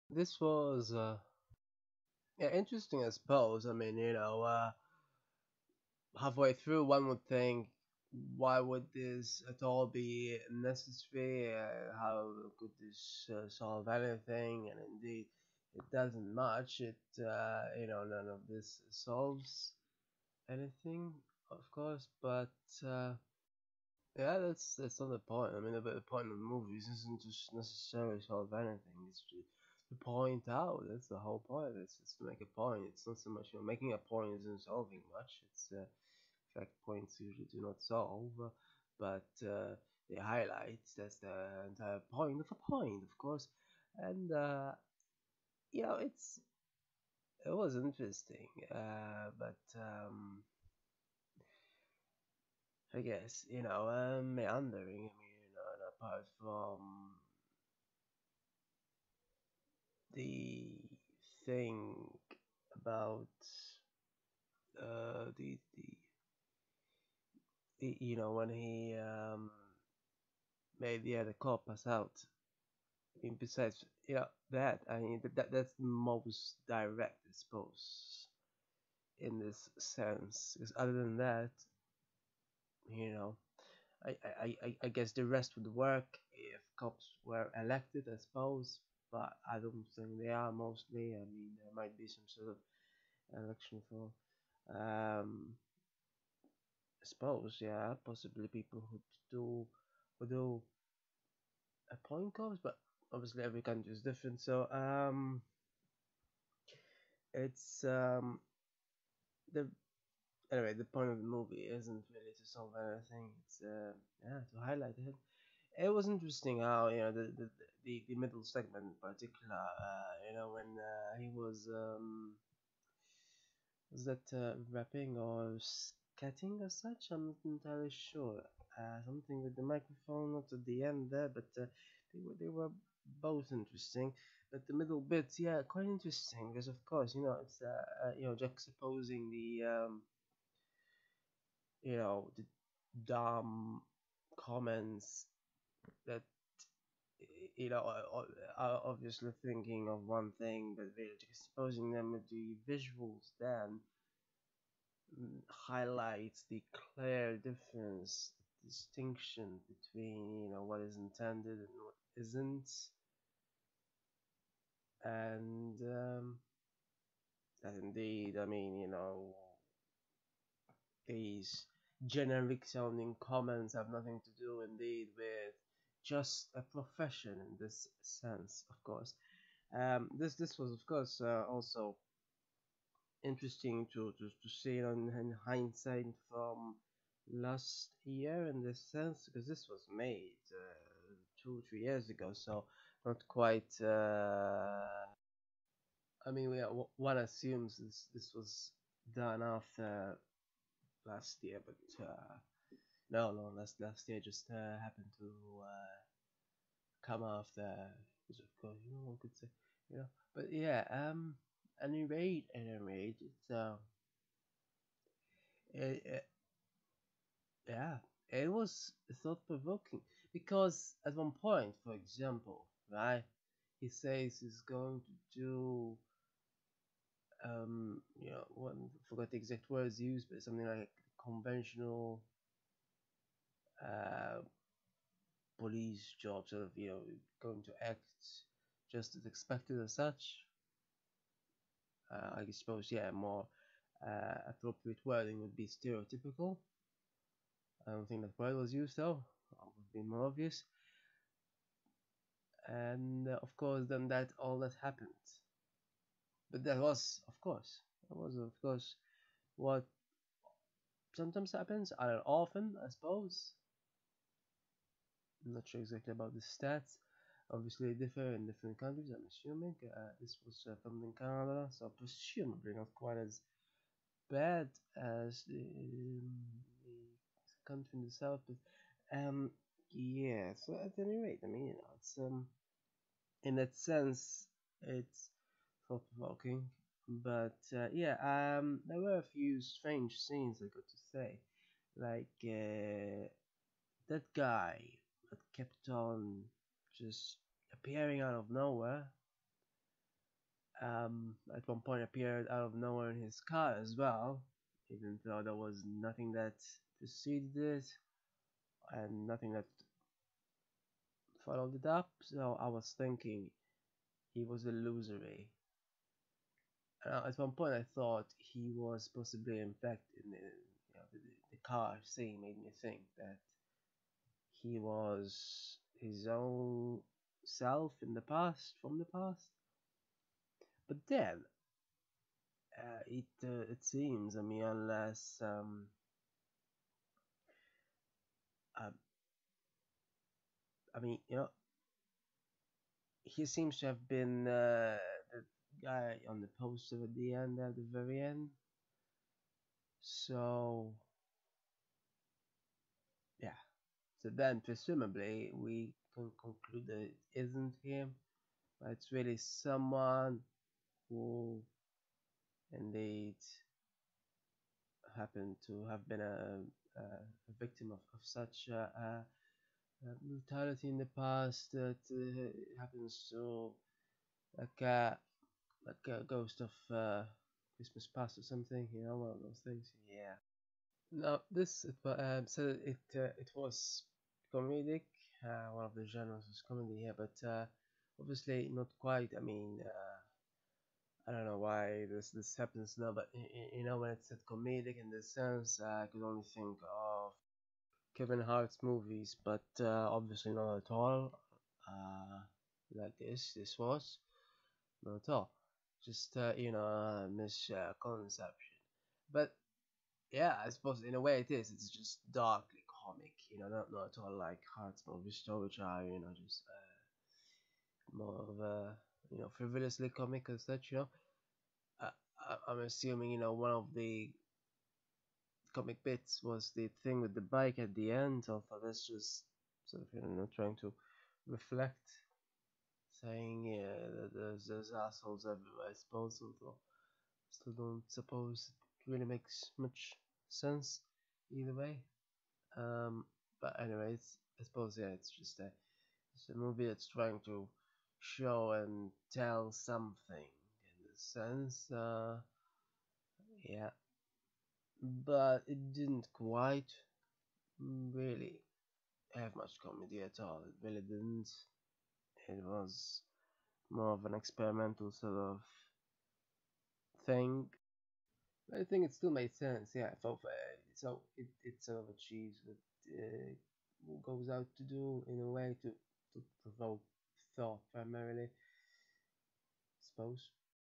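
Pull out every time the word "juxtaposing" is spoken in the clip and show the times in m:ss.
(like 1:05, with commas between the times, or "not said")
2:18.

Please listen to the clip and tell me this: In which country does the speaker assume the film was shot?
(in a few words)
Canada.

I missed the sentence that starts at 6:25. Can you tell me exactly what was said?
Uh, one of the genres was comedy here, but uh, obviously not quite.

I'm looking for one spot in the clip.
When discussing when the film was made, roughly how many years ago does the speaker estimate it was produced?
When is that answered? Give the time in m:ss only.
3:11.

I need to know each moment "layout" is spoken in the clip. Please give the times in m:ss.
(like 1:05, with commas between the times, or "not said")
not said.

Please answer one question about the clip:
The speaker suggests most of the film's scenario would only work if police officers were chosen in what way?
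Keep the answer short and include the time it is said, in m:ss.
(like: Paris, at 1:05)
Elected, at 1:27.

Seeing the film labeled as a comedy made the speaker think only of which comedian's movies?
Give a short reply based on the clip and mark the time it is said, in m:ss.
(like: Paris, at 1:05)
Kevin Hart, at 6:38.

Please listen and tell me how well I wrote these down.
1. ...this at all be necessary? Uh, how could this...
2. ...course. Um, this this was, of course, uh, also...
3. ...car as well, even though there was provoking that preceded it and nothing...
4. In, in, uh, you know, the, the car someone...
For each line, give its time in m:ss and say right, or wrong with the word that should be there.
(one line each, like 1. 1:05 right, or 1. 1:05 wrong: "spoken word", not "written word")
1. 0:08 right
2. 2:58 right
3. 5:03 wrong: "nothing", not "provoking"
4. 5:20 wrong: "scene", not "someone".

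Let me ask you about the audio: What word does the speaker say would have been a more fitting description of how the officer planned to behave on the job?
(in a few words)
Stereotypical.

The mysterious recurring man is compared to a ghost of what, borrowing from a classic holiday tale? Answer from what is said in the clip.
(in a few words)
Christmas past.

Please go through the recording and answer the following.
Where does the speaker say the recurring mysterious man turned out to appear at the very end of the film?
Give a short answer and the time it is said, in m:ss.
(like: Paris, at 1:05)
On the poster, at 5:46.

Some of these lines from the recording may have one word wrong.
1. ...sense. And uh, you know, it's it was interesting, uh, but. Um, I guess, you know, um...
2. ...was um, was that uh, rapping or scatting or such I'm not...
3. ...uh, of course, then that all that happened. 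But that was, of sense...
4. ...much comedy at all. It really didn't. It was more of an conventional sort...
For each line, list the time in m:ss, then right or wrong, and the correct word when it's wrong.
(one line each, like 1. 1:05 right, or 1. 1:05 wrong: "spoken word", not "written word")
1. 0:43 wrong: "course", not "sense"
2. 2:01 right
3. 4:13 wrong: "course", not "sense"
4. 7:39 wrong: "experimental", not "conventional".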